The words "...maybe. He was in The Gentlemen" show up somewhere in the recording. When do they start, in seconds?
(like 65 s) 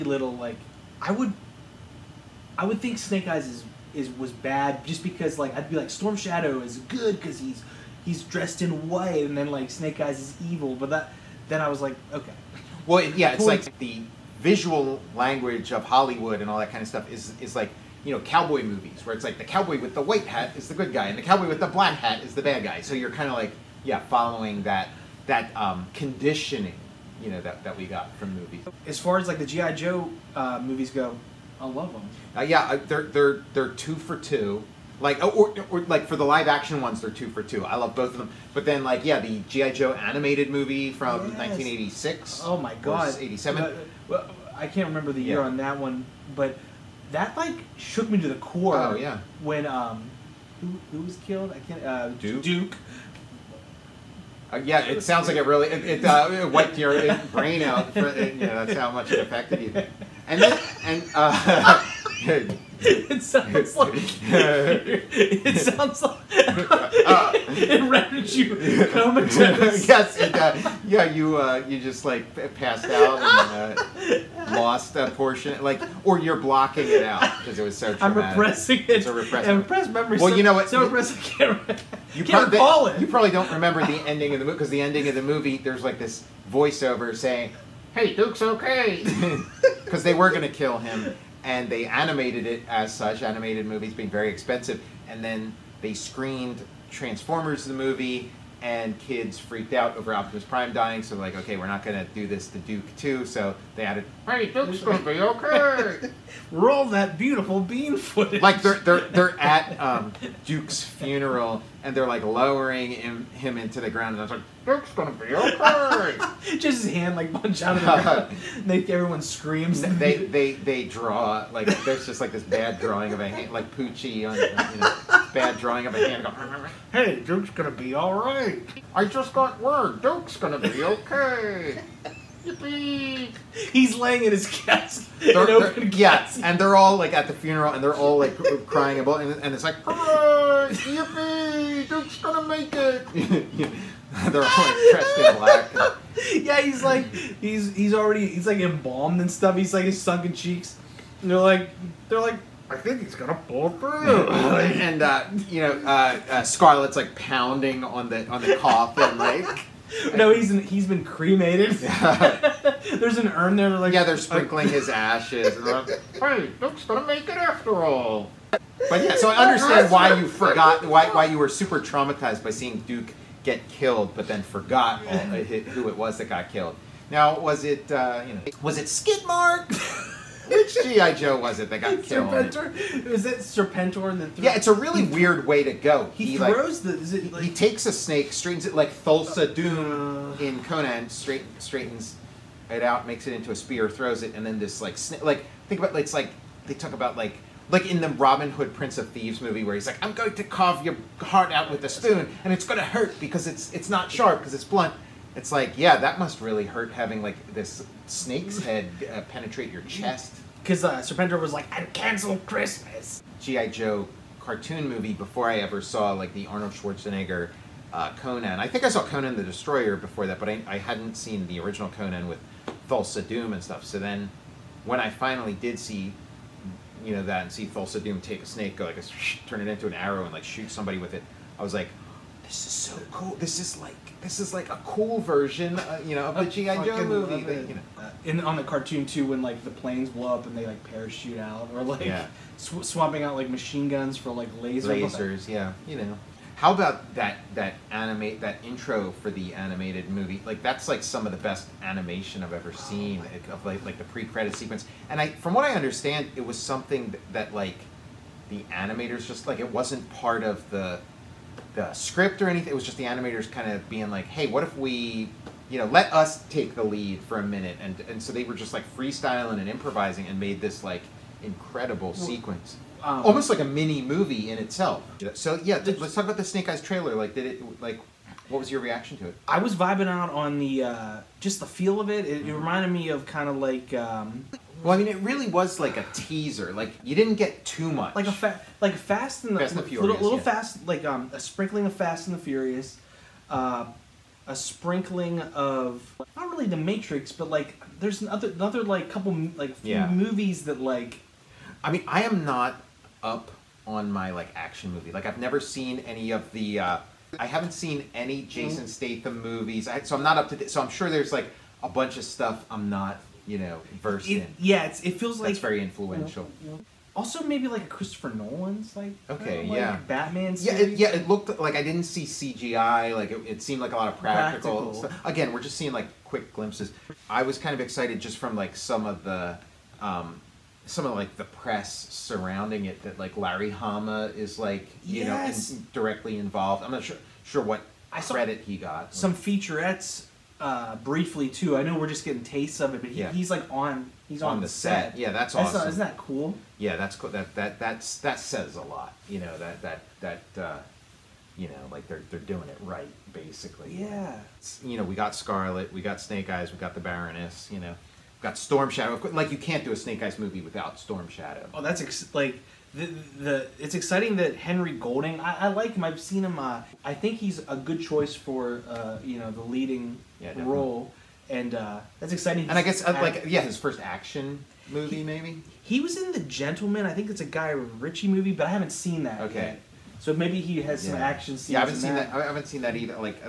375 s.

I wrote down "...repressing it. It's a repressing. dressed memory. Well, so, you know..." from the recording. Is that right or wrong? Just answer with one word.
wrong.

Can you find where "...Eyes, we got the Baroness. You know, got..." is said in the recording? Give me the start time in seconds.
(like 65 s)
356 s.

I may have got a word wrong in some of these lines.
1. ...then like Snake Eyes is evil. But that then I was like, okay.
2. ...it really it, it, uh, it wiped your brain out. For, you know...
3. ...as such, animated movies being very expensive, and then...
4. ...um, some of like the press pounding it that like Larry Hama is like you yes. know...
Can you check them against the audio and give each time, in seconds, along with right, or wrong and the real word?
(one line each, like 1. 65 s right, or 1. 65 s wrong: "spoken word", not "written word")
1. 9 s right
2. 55 s right
3. 92 s right
4. 330 s wrong: "surrounding", not "pounding".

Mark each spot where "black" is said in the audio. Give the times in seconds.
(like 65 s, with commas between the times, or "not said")
21 s, 145 s.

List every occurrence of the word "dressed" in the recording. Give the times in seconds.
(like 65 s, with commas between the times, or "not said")
8 s, 144 s.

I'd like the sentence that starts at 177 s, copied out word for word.
Now, was it, uh, you know, was it Skidmark?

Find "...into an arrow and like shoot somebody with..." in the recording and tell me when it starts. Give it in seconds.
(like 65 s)
229 s.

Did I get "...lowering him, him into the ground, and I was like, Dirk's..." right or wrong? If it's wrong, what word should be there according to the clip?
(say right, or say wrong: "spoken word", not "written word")
right.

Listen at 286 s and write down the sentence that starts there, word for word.
Like you didn't get too much.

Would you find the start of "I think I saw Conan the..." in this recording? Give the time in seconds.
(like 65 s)
218 s.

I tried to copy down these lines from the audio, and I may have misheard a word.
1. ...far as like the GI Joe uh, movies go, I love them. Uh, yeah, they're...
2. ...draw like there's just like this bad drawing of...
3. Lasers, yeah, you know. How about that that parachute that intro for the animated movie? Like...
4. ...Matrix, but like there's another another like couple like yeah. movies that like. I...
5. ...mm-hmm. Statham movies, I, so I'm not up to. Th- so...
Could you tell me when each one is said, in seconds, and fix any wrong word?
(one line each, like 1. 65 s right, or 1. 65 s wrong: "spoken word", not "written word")
1. 28 s right
2. 120 s right
3. 245 s wrong: "animate", not "parachute"
4. 296 s right
5. 308 s right.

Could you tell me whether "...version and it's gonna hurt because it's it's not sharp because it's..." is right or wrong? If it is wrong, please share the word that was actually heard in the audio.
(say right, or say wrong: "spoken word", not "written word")
wrong: "spoon", not "version".